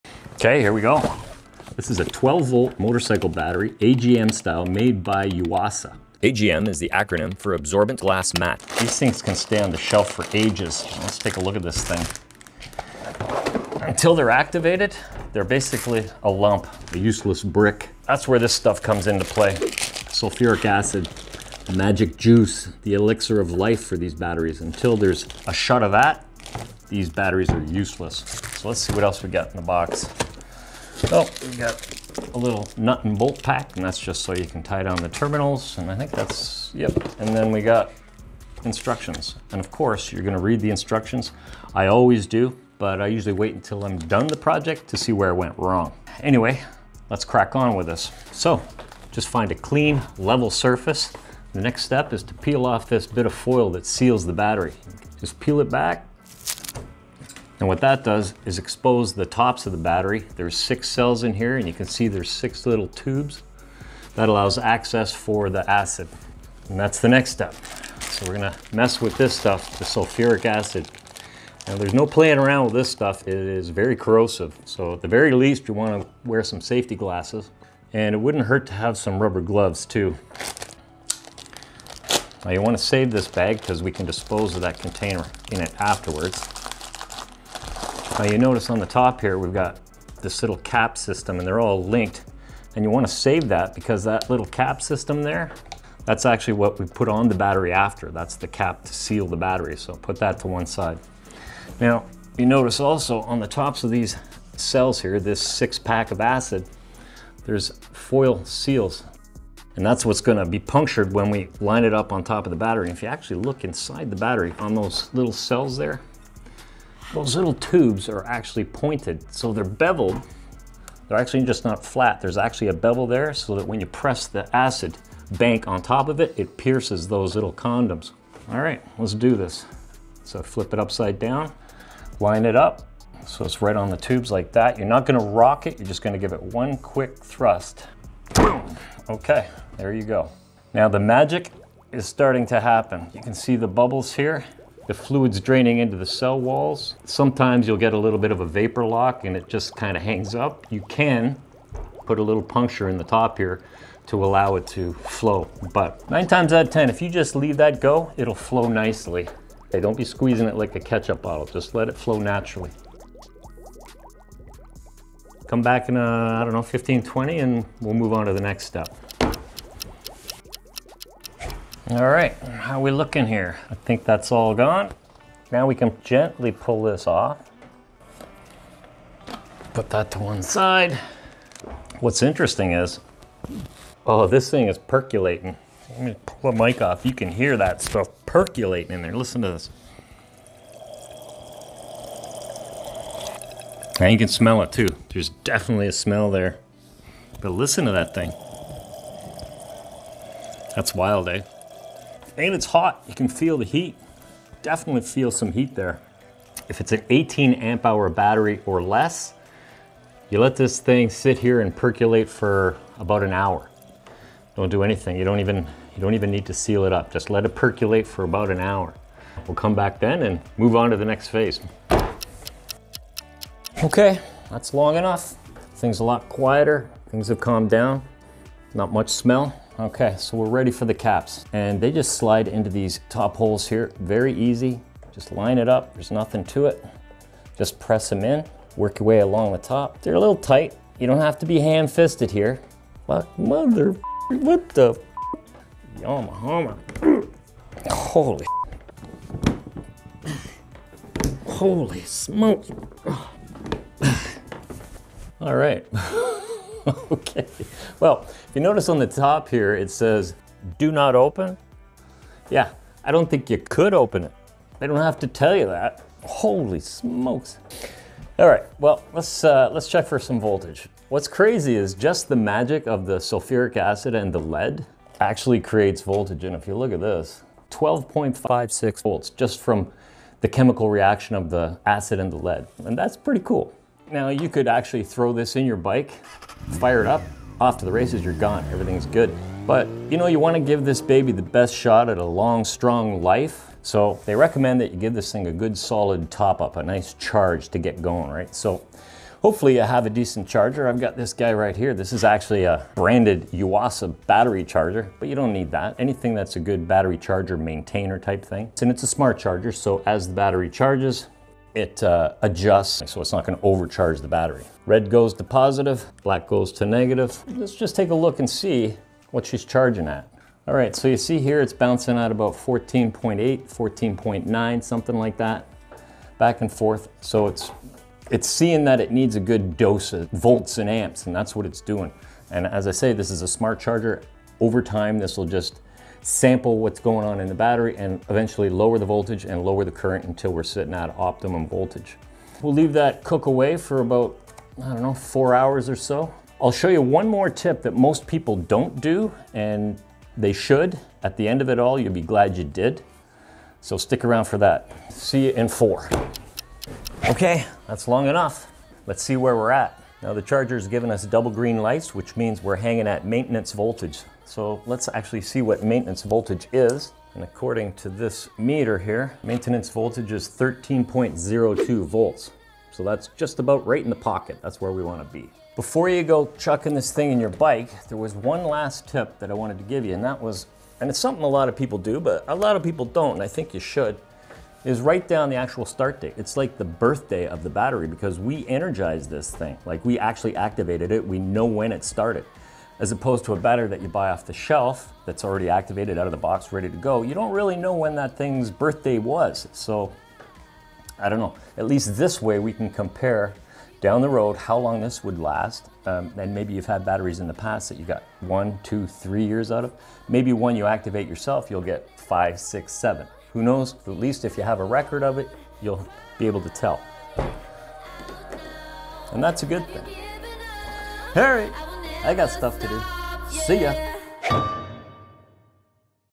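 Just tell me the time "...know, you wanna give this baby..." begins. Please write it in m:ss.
4:50.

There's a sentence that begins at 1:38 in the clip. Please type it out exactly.
That's the cap to seal the battery.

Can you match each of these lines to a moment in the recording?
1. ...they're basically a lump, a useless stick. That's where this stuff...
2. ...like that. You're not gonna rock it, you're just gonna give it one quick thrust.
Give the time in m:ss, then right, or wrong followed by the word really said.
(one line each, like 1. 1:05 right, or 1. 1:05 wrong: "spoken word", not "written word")
1. 0:15 wrong: "brick", not "stick"
2. 2:14 right.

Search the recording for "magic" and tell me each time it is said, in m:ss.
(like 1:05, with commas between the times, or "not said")
0:21, 2:20, 4:32.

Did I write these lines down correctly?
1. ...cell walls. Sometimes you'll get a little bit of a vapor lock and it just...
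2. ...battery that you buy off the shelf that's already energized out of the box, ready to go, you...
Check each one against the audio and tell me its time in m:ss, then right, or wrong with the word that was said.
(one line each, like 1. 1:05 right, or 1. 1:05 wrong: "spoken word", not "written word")
1. 2:26 right
2. 6:33 wrong: "activated", not "energized".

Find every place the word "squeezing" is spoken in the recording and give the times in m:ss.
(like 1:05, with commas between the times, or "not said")
2:40.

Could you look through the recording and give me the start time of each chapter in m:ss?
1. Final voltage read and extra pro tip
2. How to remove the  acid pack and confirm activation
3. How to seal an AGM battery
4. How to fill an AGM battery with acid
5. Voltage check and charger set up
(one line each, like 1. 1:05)
1. 5:57
2. 2:51
3. 3:42
4. 0:48
5. 4:27.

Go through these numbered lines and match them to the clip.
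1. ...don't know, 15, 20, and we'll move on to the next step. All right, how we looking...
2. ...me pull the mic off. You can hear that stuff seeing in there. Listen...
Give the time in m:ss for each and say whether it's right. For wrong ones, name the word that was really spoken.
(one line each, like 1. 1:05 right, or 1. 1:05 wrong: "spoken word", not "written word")
1. 2:46 right
2. 3:06 wrong: "percolating", not "seeing".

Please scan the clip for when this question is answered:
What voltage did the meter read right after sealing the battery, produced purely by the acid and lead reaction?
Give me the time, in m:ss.
4:37.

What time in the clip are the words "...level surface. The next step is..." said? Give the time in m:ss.
0:50.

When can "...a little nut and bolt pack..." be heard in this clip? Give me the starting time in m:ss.
0:32.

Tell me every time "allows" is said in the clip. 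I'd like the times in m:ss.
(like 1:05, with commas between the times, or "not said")
1:04, 2:34.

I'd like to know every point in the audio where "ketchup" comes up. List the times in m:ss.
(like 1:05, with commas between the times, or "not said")
2:40.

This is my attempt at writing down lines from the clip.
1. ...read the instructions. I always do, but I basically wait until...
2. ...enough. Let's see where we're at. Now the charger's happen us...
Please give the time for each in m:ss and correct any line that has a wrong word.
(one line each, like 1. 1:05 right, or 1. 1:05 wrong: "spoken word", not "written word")
1. 0:40 wrong: "usually", not "basically"
2. 5:58 wrong: "given", not "happen".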